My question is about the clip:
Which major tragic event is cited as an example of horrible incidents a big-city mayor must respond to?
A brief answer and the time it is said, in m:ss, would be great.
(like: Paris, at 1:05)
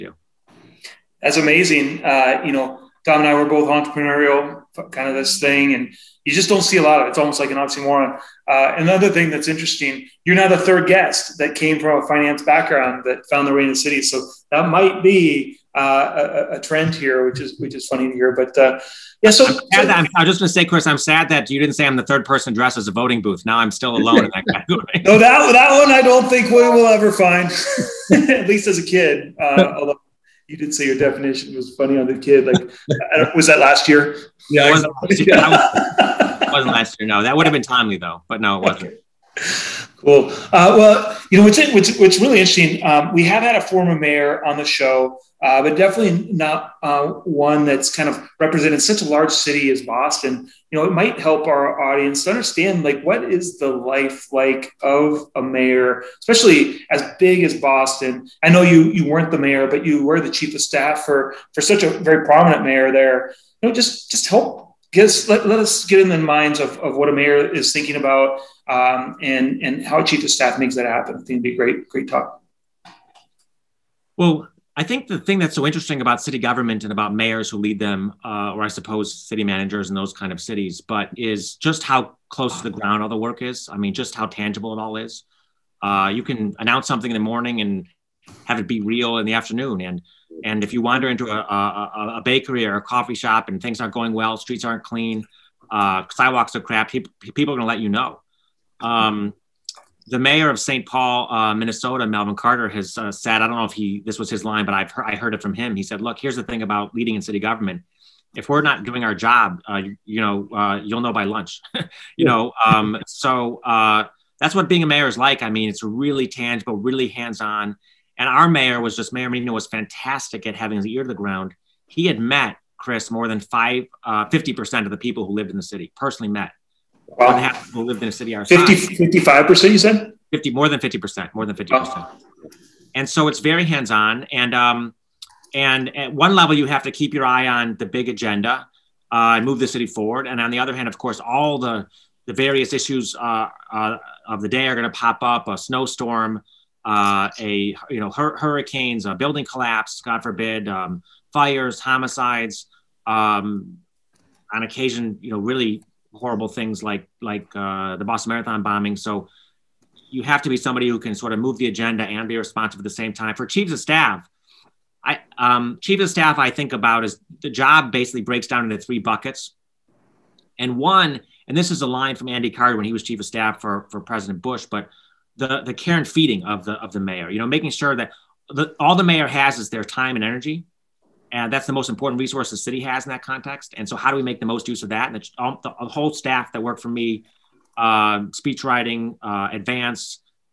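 Boston Marathon bombing, at 2:38.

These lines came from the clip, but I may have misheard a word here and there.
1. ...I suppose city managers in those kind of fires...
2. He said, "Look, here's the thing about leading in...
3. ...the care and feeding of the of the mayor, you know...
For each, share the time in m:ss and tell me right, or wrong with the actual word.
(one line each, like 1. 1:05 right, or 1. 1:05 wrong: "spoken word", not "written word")
1. 1:18 wrong: "cities", not "fires"
2. 1:45 right
3. 2:55 right.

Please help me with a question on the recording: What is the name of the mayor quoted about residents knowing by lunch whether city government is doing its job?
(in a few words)
Melvin Carter.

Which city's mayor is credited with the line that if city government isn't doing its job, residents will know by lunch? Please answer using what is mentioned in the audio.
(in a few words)
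St. Paul.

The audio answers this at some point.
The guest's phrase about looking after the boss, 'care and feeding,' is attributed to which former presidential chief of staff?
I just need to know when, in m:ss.
2:52.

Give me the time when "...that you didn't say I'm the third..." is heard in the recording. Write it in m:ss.
0:21.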